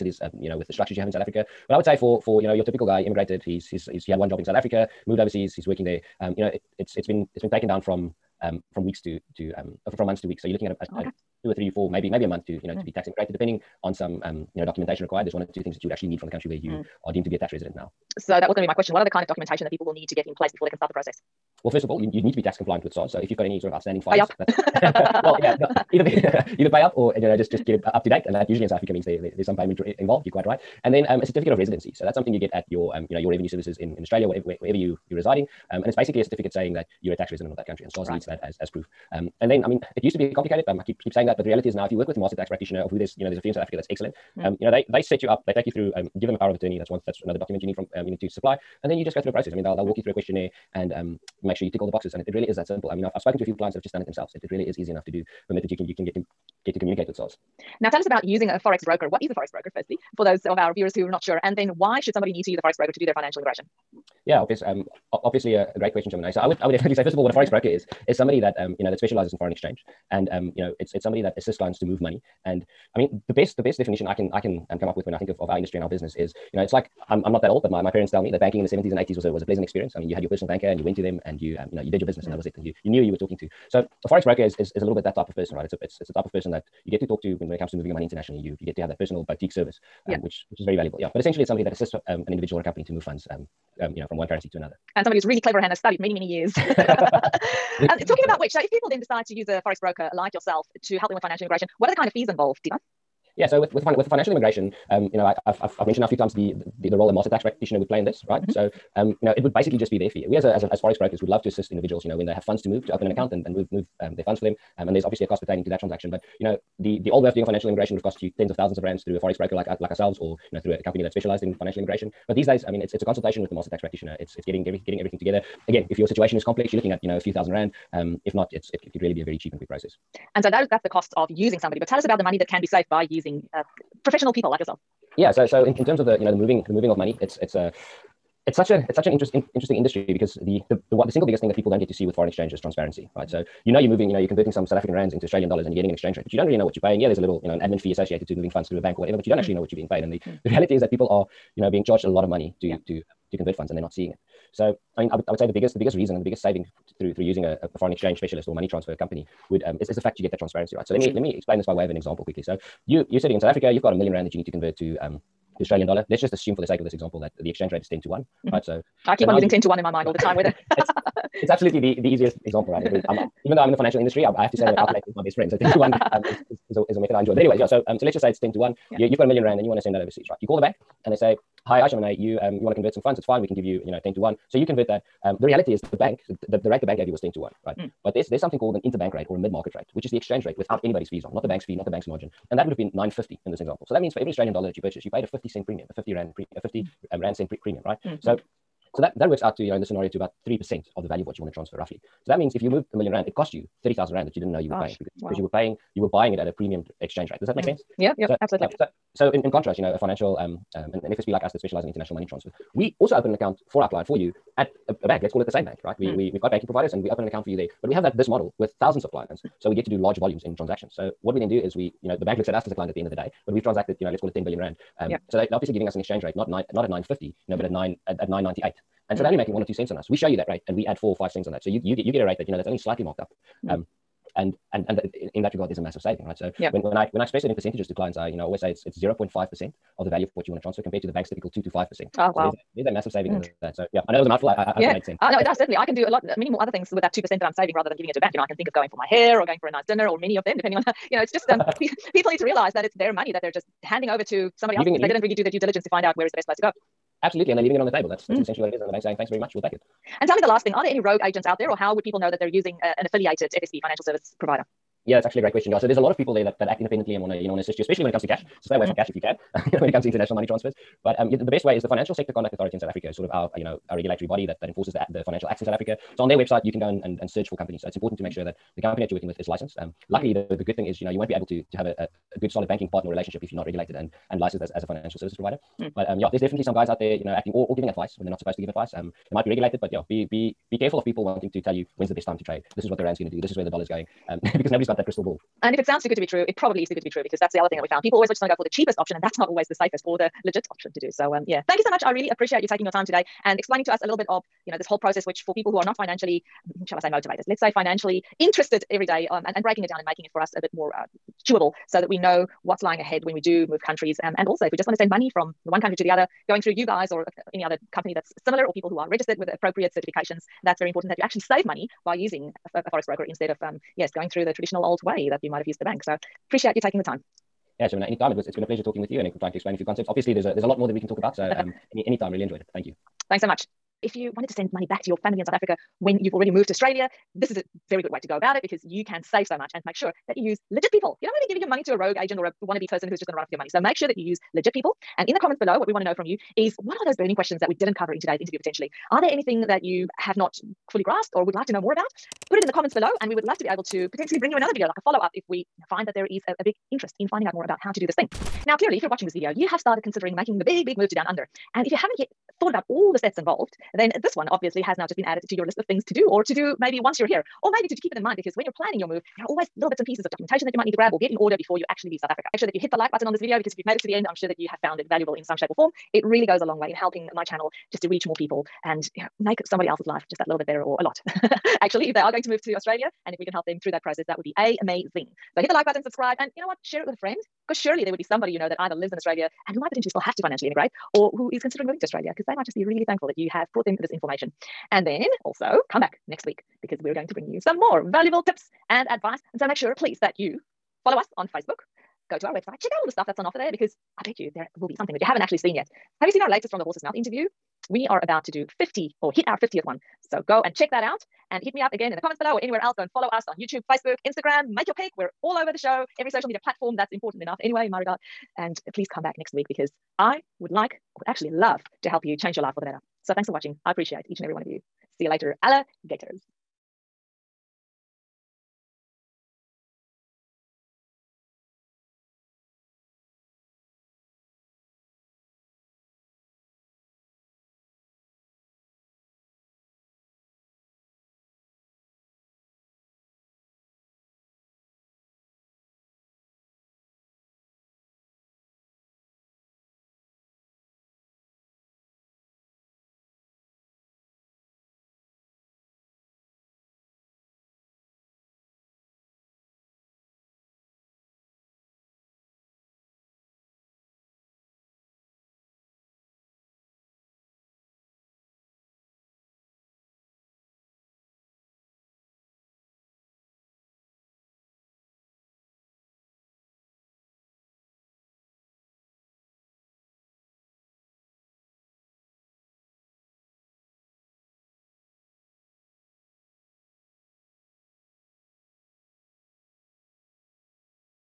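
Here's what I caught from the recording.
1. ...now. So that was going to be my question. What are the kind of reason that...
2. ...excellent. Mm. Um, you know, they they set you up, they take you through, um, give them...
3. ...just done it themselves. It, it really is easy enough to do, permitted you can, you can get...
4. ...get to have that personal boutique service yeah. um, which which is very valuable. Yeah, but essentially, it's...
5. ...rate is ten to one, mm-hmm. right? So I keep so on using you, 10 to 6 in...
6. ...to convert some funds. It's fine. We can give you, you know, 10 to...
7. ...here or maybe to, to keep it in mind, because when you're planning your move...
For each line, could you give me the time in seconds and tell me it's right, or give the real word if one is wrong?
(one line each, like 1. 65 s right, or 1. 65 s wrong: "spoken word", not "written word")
1. 17 s wrong: "documentation", not "reason"
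2. 43 s right
3. 53 s right
4. 88 s right
5. 167 s wrong: "1", not "6"
6. 182 s right
7. 367 s right.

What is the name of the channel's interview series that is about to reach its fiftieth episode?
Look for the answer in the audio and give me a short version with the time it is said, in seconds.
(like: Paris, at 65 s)
From the Horse's Mouth, at 406 s.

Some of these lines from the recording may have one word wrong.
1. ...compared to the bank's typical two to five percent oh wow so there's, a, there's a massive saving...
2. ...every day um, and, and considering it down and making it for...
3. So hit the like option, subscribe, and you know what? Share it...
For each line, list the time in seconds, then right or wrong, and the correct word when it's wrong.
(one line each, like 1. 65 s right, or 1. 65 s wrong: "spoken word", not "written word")
1. 240 s right
2. 308 s wrong: "breaking", not "considering"
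3. 385 s wrong: "button", not "option".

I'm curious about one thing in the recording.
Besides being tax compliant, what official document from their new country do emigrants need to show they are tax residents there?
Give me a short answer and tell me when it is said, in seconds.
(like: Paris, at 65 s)
certificate of residency, at 31 s.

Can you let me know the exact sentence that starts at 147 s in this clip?
Yeah, there's a little, you know, an admin fee associated to moving funds through a bank or whatever, but you don't mm.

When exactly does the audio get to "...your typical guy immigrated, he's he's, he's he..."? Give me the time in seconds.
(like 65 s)
2 s.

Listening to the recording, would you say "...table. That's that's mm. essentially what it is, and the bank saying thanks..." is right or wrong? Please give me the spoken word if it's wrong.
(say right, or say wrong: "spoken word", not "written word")
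right.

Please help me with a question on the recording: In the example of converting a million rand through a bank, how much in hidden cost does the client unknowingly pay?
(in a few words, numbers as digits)
30,000 rand.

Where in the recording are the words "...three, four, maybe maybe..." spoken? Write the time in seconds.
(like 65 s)
11 s.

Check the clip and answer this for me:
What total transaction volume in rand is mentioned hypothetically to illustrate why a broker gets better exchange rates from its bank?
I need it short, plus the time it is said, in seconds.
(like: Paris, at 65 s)
10 billion rand, at 224 s.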